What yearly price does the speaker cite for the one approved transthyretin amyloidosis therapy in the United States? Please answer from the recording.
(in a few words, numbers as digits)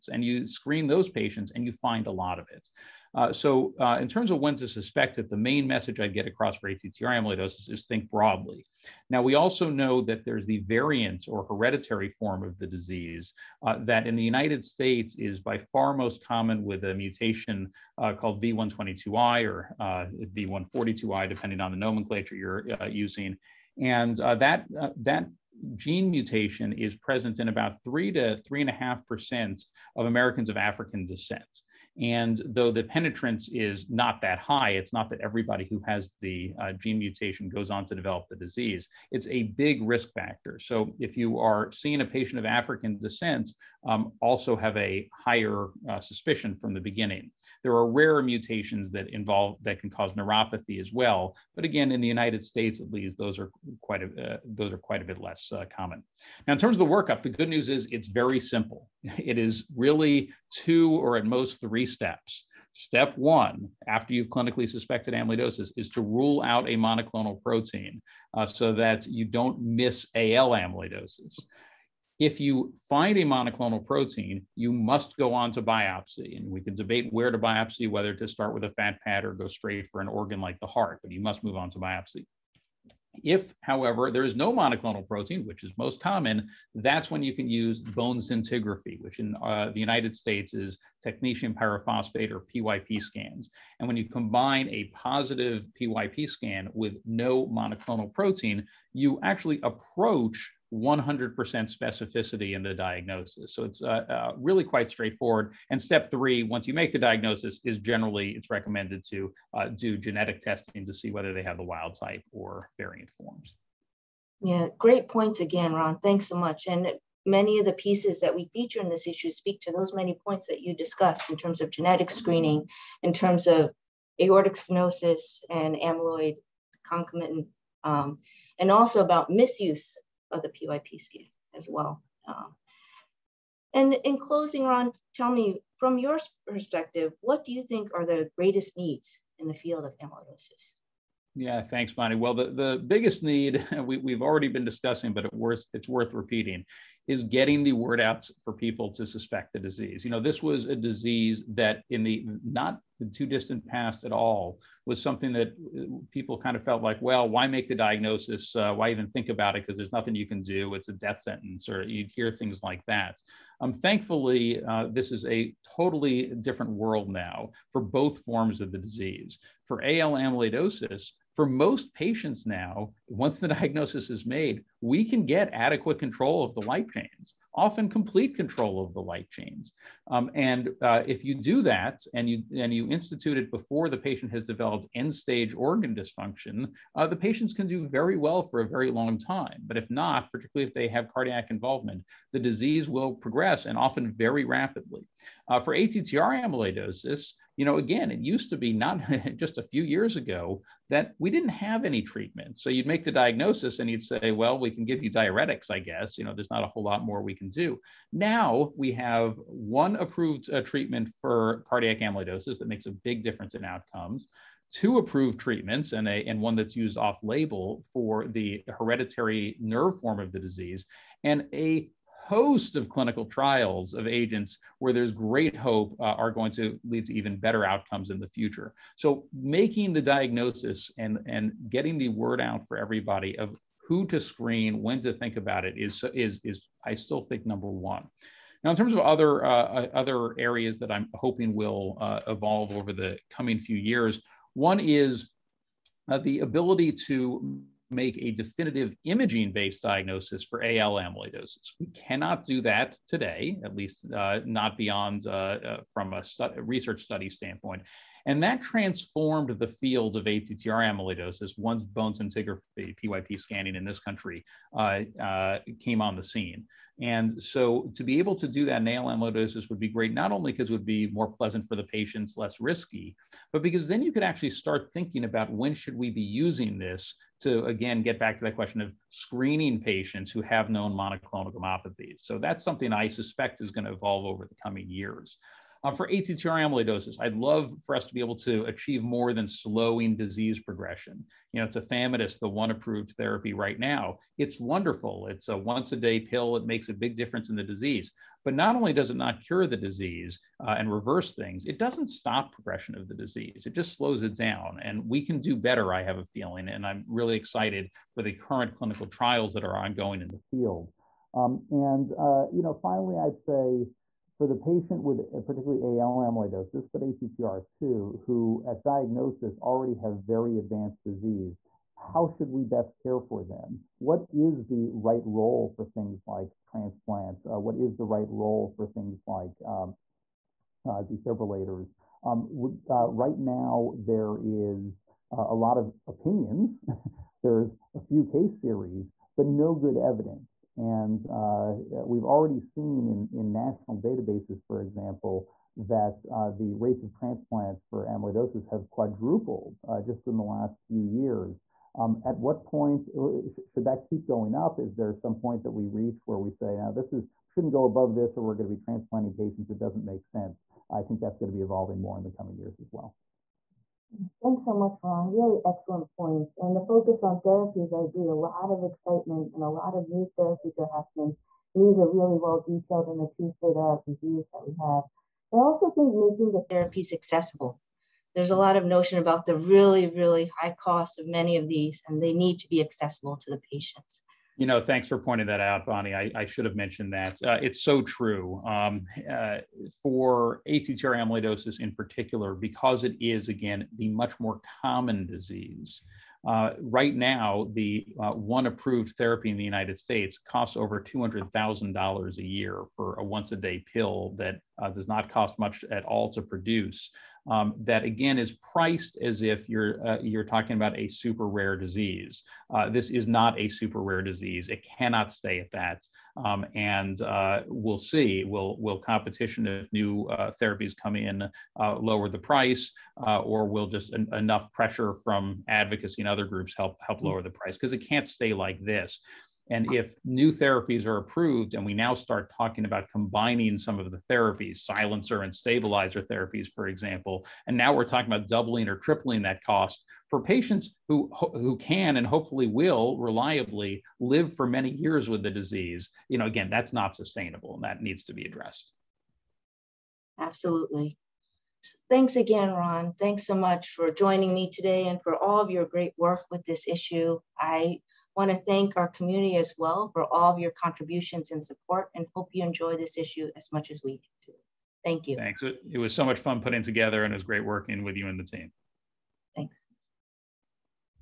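Over $200,000.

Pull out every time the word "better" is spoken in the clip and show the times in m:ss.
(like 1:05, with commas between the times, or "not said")
3:47, 5:05.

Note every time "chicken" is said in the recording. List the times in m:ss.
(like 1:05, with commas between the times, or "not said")
not said.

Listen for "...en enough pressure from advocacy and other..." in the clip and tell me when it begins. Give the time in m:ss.
7:04.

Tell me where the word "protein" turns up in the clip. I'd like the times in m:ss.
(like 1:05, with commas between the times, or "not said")
1:07, 1:13, 1:25, 1:38.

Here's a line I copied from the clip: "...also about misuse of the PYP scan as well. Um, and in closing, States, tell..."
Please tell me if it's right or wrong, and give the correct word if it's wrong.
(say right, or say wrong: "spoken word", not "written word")
wrong: "Ron", not "States".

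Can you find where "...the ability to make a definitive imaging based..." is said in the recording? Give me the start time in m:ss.
4:06.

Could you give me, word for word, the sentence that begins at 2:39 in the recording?
Because there's nothing you can do.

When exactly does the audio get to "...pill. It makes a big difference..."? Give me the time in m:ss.
4:56.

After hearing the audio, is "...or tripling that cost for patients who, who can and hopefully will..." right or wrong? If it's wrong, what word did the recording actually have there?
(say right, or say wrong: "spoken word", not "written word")
right.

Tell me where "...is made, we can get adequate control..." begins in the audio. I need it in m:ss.
2:54.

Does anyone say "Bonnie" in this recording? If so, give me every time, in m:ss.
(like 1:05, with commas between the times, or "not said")
2:21, 6:25.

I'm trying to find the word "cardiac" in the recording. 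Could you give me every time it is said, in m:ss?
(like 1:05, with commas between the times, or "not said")
3:11, 3:31.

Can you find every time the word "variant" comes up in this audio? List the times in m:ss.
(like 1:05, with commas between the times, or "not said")
0:10, 1:52.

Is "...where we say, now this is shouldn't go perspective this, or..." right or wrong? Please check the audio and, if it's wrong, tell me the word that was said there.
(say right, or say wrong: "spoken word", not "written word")
wrong: "above", not "perspective".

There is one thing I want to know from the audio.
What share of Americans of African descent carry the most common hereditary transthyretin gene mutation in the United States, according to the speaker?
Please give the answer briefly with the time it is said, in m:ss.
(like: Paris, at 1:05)
3 to 3.5 percent, at 0:27.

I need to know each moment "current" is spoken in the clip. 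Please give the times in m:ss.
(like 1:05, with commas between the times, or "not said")
5:08.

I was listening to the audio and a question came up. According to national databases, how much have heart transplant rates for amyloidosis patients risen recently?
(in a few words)
Quadrupled.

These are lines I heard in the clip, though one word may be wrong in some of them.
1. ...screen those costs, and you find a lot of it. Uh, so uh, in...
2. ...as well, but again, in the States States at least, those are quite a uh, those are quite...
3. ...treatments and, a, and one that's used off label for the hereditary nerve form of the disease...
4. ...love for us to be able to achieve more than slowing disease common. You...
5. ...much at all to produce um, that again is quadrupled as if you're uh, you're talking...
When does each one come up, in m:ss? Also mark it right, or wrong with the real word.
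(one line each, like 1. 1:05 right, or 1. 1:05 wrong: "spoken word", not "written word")
1. 0:00 wrong: "patients", not "costs"
2. 0:50 wrong: "United", not "States"
3. 3:35 right
4. 4:47 wrong: "progression", not "common"
5. 6:45 wrong: "priced", not "quadrupled".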